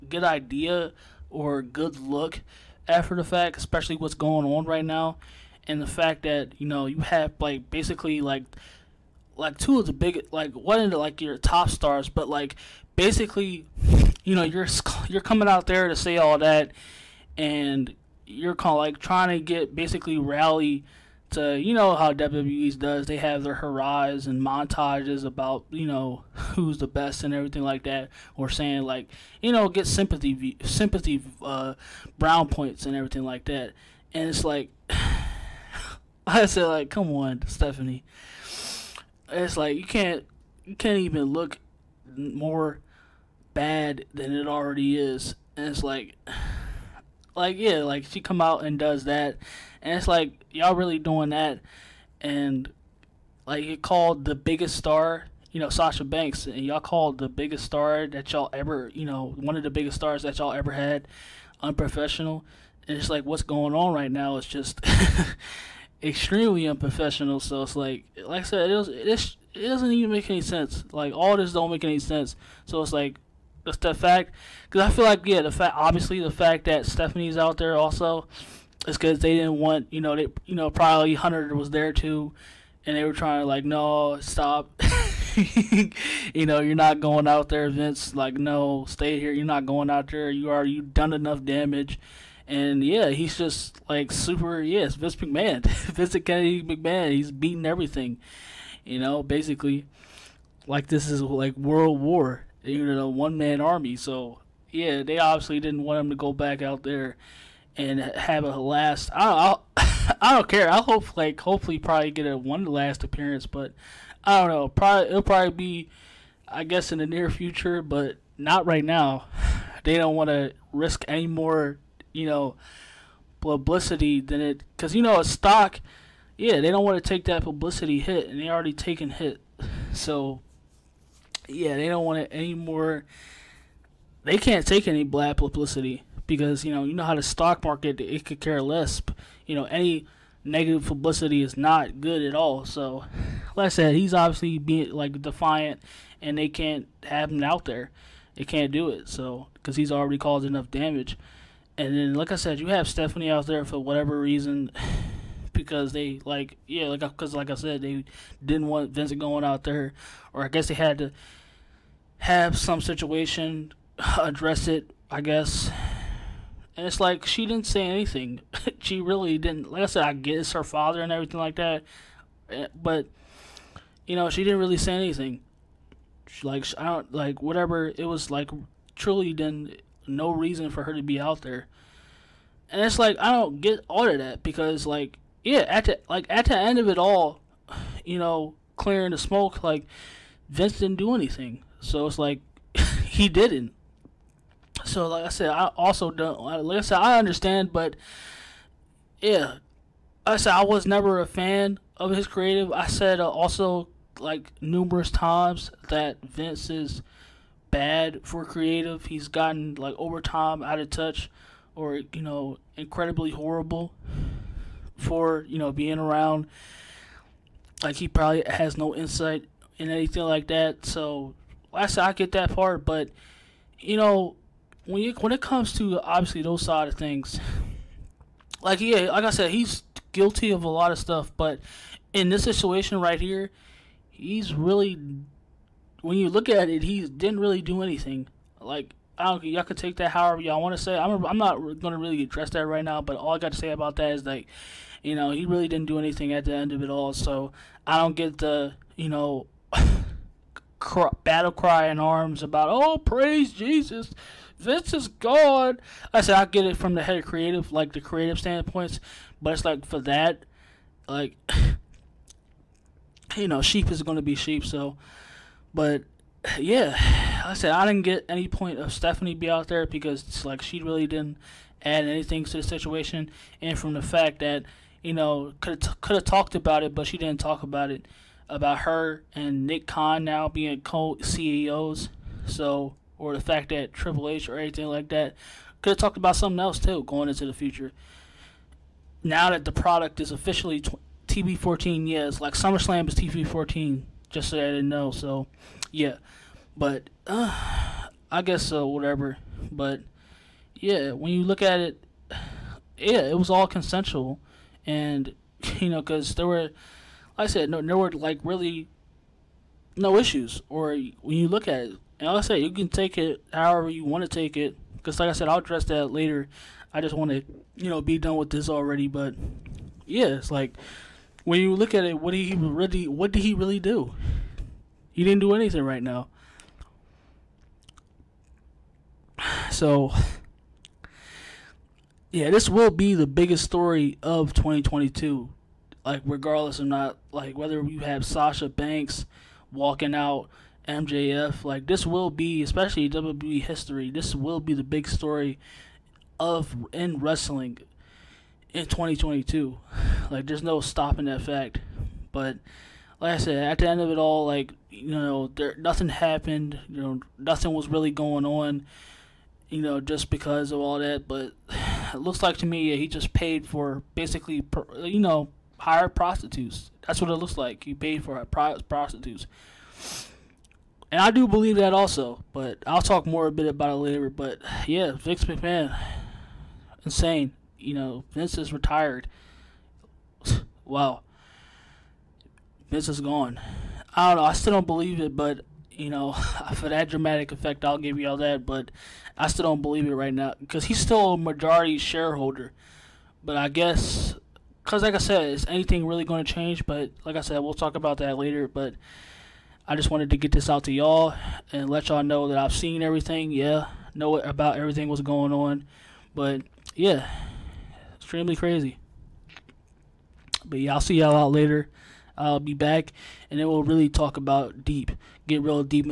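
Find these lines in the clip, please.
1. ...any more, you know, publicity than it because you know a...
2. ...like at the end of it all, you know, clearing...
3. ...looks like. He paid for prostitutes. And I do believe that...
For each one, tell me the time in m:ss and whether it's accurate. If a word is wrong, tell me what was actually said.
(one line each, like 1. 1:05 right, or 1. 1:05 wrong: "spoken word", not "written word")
1. 2:01 right
2. 3:06 right
3. 6:07 right.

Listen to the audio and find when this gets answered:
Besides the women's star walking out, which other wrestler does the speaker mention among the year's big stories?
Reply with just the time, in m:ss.
5:40.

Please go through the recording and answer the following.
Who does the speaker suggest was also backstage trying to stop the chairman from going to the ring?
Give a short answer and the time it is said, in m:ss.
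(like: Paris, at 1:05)
Hunter, at 1:21.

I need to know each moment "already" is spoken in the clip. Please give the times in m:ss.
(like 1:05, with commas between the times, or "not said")
0:44, 2:08, 2:29, 5:18.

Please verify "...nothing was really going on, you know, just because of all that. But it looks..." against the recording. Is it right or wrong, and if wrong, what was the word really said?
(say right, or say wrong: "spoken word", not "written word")
right.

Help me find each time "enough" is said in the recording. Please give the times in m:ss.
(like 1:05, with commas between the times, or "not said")
1:31, 2:30.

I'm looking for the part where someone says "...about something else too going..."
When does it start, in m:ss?
4:46.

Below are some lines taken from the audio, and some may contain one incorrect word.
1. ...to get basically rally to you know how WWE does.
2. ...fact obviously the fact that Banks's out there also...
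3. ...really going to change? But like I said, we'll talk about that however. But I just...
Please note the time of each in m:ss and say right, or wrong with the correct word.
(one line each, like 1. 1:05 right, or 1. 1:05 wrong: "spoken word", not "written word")
1. 0:19 right
2. 1:15 wrong: "Stephanie", not "Banks"
3. 6:36 wrong: "later", not "however".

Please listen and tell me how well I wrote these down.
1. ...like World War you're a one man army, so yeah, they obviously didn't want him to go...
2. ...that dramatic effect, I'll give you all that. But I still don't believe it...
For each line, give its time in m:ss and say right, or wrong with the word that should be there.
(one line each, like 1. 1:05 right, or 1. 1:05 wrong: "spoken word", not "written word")
1. 1:41 right
2. 6:26 right.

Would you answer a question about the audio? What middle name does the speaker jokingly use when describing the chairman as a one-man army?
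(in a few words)
Kennedy.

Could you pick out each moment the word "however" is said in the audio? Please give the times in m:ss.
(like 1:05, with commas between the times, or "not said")
4:00, 5:13.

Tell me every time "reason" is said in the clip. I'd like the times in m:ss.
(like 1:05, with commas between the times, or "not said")
2:34, 3:00.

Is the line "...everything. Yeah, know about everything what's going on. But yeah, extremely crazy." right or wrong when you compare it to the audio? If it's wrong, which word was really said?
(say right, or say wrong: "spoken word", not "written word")
right.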